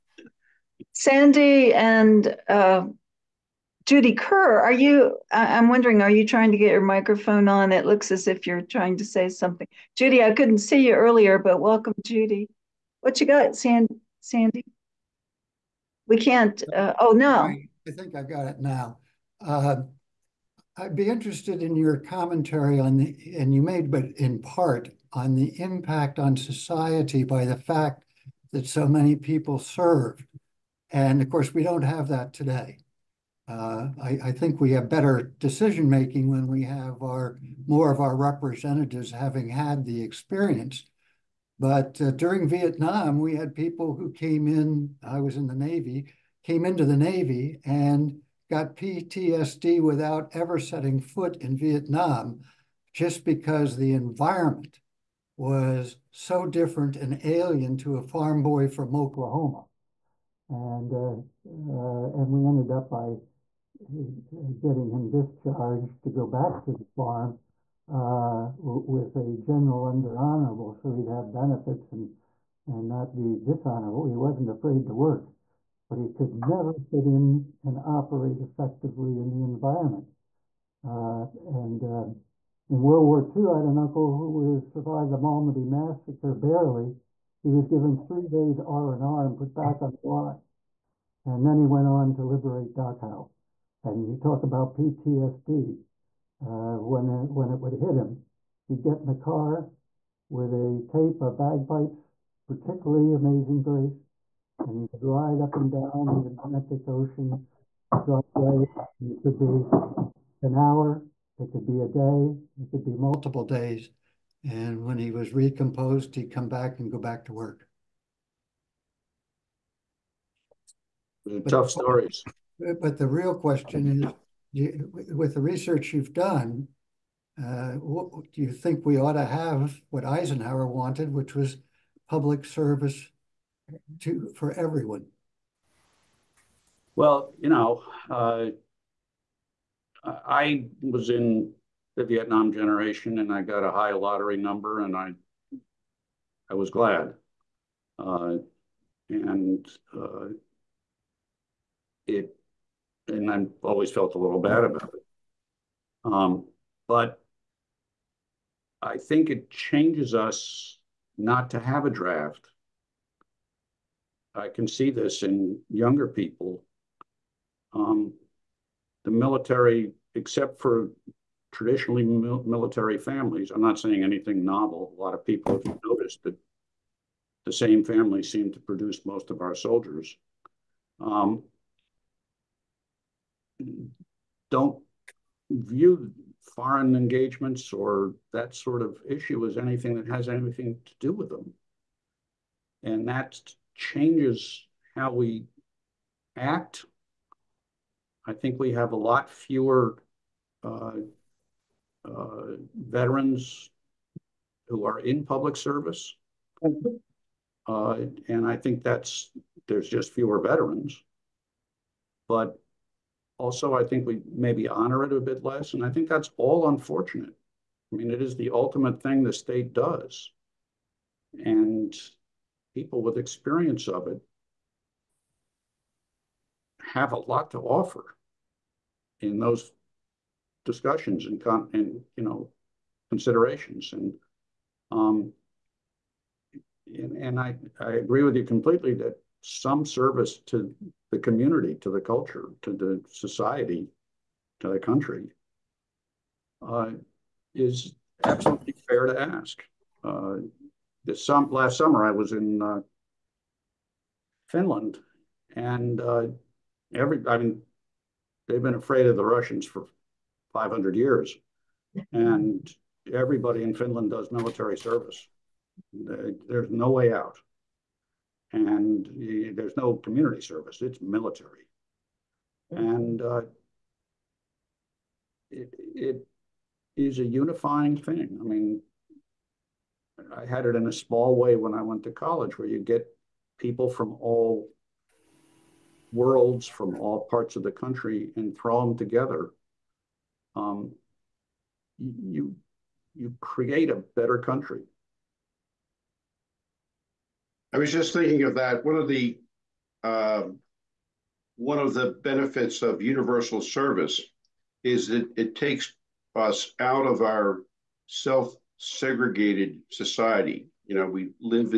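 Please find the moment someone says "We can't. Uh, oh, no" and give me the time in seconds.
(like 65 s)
16 s.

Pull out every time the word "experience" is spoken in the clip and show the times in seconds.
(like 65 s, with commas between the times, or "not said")
40 s, 223 s.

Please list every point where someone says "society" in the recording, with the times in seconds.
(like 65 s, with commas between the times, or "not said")
26 s, 243 s, 309 s.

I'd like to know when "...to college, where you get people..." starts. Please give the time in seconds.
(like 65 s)
282 s.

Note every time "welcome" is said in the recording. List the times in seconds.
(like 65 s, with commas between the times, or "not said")
11 s.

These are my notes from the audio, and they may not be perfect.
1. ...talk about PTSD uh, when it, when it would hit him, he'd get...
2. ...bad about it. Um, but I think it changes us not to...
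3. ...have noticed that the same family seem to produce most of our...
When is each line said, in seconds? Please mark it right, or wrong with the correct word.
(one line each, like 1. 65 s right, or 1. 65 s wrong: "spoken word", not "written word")
1. 94 s right
2. 154 s right
3. 175 s right.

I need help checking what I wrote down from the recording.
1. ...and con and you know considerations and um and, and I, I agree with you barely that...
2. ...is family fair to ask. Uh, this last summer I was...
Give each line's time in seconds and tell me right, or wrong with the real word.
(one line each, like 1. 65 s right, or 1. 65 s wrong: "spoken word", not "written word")
1. 231 s wrong: "completely", not "barely"
2. 247 s wrong: "absolutely", not "family".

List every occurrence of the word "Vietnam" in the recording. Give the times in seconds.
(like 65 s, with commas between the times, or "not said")
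42 s, 51 s, 142 s.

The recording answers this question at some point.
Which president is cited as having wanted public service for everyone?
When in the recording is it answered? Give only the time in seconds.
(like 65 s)
130 s.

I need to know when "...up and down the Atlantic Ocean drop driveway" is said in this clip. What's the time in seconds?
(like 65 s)
105 s.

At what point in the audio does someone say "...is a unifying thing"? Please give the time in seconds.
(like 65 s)
276 s.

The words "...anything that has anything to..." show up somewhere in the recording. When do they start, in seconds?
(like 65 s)
189 s.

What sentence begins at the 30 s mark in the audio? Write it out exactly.
And of course, we don't have that today.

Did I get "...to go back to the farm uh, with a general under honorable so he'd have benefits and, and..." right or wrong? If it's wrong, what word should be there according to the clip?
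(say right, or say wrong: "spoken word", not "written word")
right.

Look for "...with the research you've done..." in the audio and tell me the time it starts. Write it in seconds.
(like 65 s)
125 s.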